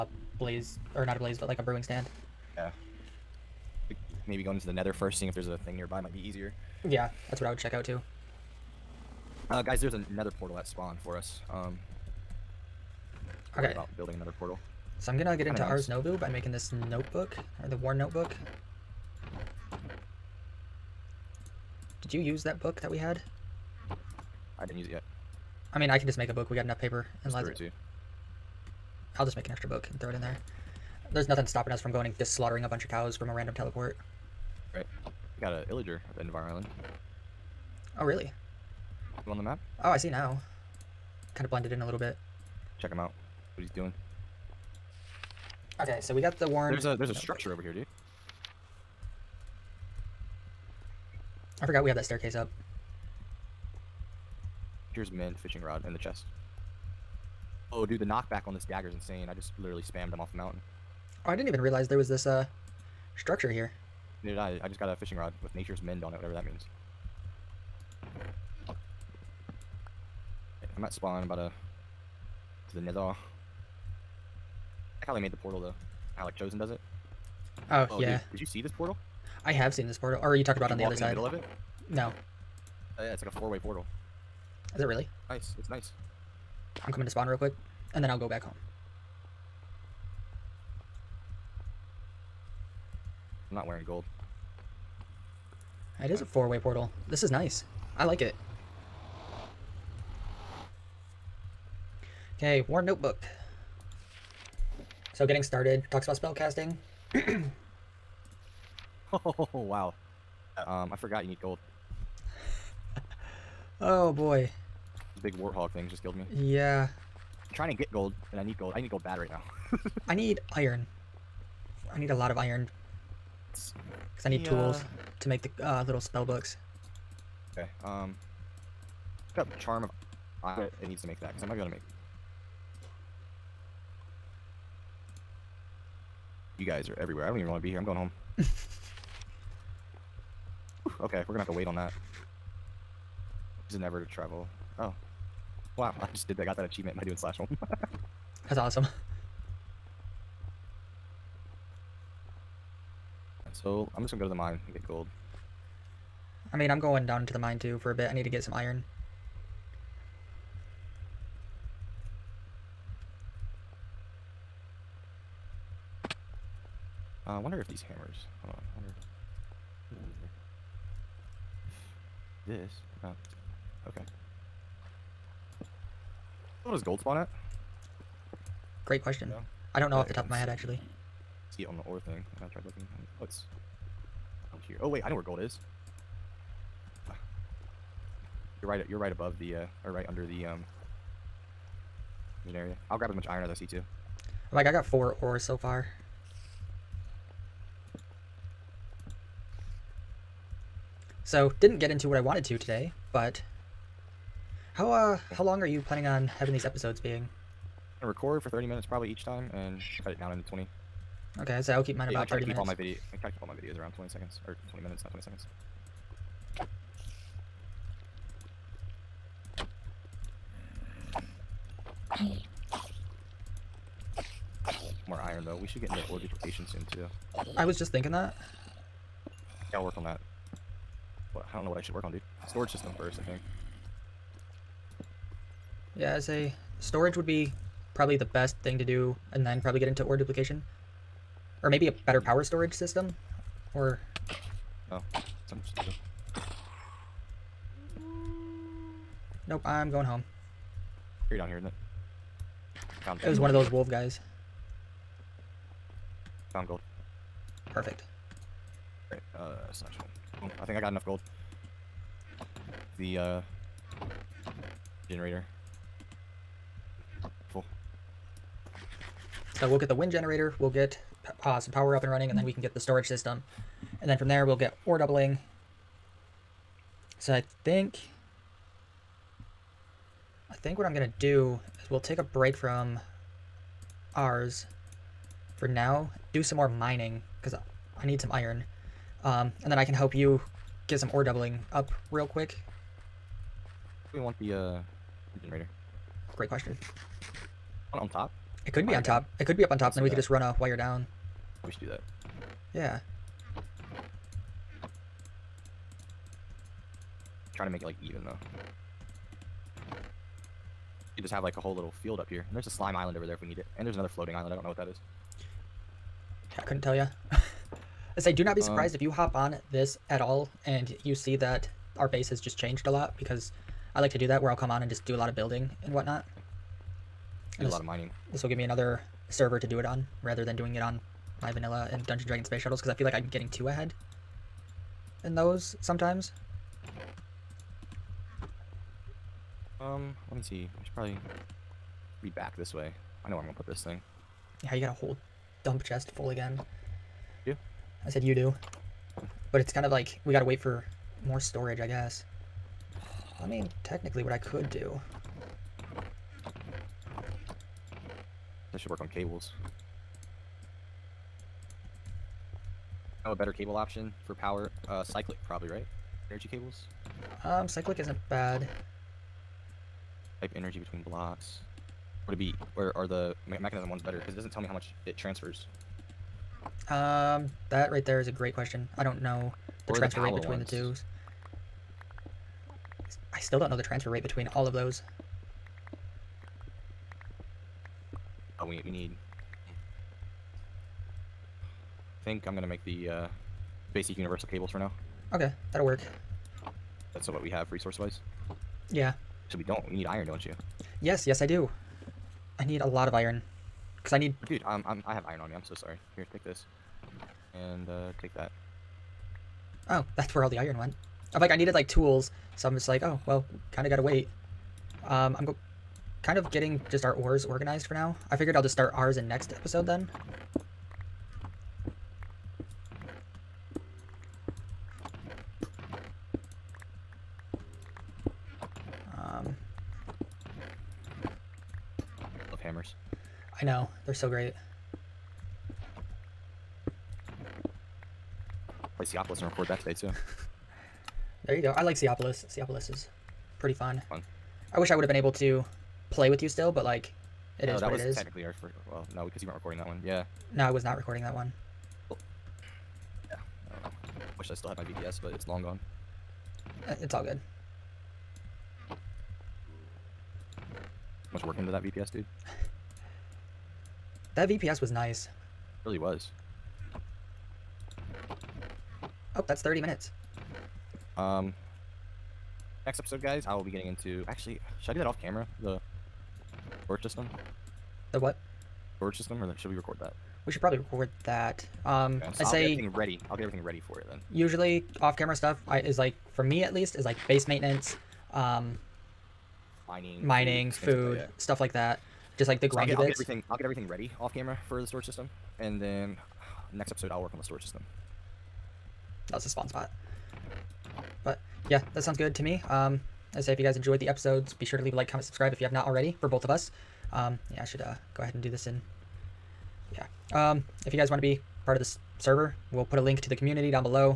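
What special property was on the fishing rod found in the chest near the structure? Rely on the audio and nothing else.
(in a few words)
Nature's mend.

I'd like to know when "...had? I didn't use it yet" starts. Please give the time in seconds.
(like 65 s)
22 s.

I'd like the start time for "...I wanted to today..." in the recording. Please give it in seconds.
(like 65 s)
202 s.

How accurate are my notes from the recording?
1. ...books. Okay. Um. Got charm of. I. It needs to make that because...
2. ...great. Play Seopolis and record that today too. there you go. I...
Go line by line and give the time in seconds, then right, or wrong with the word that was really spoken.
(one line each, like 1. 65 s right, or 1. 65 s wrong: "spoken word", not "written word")
1. 126 s right
2. 434 s right.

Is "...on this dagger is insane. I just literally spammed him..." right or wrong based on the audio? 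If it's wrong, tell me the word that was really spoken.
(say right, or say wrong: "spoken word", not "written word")
right.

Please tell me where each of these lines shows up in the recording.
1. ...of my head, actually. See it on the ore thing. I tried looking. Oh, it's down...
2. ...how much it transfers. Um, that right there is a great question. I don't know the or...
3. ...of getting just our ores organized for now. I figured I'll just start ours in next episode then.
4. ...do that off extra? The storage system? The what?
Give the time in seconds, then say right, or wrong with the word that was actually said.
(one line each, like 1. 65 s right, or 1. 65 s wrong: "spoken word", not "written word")
1. 180 s right
2. 374 s right
3. 416 s right
4. 474 s wrong: "camera", not "extra".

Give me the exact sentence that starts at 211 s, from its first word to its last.
Okay, so I'll keep mine yeah, I try 30 to keep minutes.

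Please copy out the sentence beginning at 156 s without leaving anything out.
I mean, I'm going down into the mine too for a bit.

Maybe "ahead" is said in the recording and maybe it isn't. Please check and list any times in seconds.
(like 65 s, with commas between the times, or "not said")
333 s, 508 s.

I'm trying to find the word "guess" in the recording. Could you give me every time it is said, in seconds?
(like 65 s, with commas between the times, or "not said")
351 s.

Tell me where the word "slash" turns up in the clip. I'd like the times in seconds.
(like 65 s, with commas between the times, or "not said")
147 s, 259 s.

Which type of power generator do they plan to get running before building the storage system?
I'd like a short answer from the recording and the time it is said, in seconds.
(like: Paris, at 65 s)
Wind generator, at 269 s.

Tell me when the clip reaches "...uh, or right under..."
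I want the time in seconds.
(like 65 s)
189 s.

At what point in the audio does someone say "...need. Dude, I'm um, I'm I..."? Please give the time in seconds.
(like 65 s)
404 s.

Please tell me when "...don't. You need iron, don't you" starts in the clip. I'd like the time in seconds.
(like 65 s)
399 s.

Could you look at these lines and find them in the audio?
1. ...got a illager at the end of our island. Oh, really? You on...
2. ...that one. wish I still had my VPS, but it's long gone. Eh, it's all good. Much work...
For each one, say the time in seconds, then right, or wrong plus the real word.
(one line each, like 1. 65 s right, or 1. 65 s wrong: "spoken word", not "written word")
1. 35 s right
2. 451 s right.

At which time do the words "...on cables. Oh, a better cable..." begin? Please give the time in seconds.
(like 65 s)
359 s.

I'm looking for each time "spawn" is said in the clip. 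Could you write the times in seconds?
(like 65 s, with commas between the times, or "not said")
10 s, 70 s, 87 s, 177 s, 499 s.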